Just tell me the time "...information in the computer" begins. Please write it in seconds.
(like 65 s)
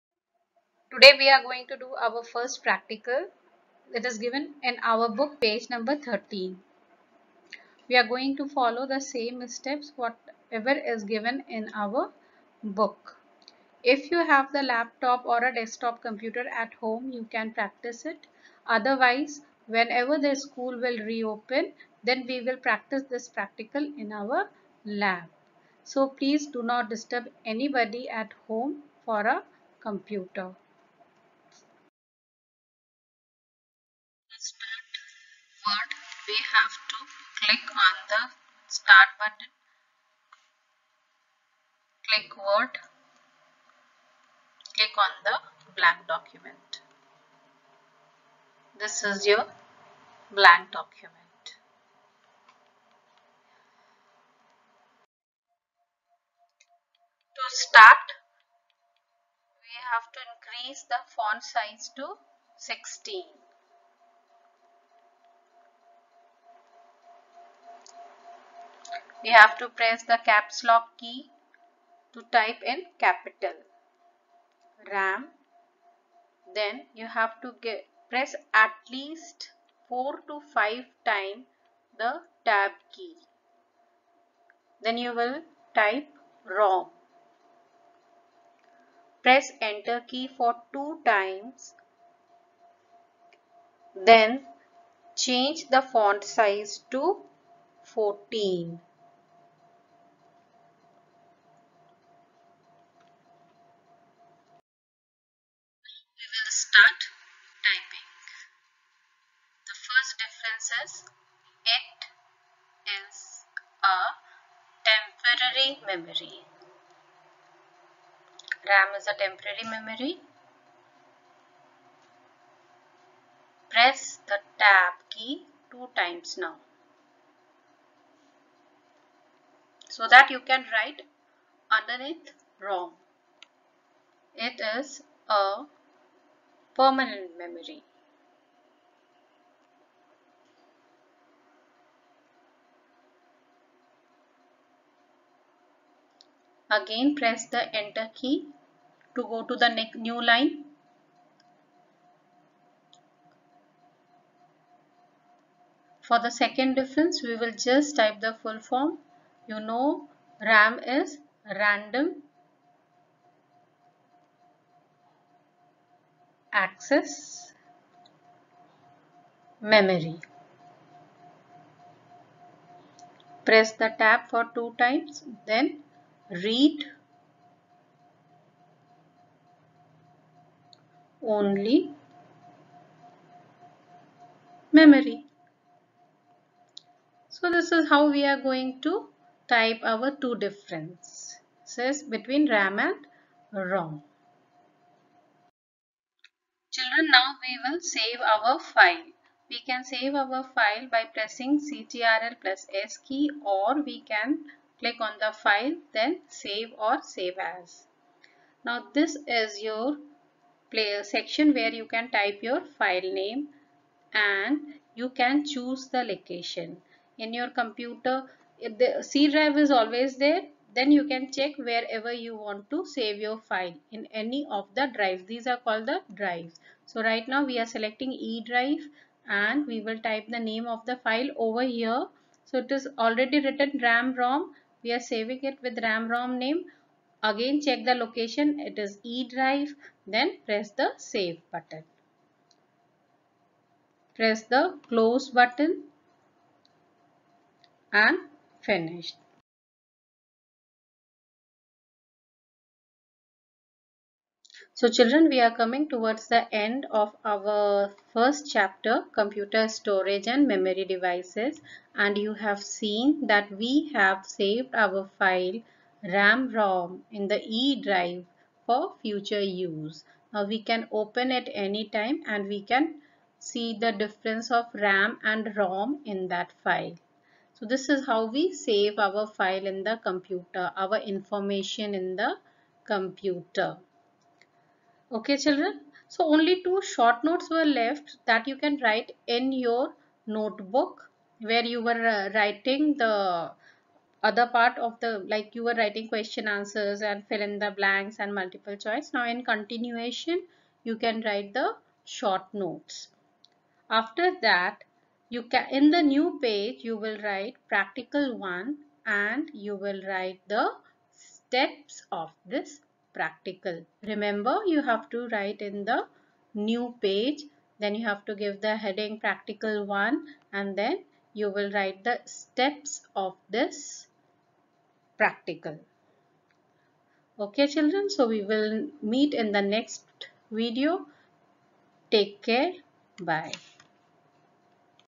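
280 s.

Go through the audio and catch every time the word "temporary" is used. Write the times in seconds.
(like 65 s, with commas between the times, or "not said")
114 s, 119 s.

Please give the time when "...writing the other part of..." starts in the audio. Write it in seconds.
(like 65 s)
292 s.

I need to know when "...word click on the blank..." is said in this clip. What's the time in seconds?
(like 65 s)
42 s.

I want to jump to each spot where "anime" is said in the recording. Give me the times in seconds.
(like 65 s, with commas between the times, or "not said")
not said.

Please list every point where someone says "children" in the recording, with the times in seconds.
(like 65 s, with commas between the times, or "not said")
196 s, 254 s, 285 s, 327 s.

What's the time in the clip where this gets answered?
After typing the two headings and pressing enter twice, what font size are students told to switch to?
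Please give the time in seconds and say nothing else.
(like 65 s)
97 s.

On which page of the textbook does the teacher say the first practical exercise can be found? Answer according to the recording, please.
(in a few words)
13.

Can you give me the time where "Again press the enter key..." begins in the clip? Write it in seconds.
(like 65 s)
146 s.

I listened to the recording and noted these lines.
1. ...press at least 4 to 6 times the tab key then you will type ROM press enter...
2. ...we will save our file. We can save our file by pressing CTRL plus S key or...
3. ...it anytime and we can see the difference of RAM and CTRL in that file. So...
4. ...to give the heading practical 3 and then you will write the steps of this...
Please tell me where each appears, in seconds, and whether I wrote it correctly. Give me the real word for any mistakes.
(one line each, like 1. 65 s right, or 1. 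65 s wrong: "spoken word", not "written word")
1. 78 s wrong: "5", not "6"
2. 197 s right
3. 271 s wrong: "ROM", not "CTRL"
4. 318 s wrong: "1", not "3".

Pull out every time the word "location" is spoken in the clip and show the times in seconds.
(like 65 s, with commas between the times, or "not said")
216 s, 238 s.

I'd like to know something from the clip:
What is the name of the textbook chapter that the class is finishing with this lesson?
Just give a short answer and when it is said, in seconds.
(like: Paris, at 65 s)
Computer storage and memory devices, at 259 s.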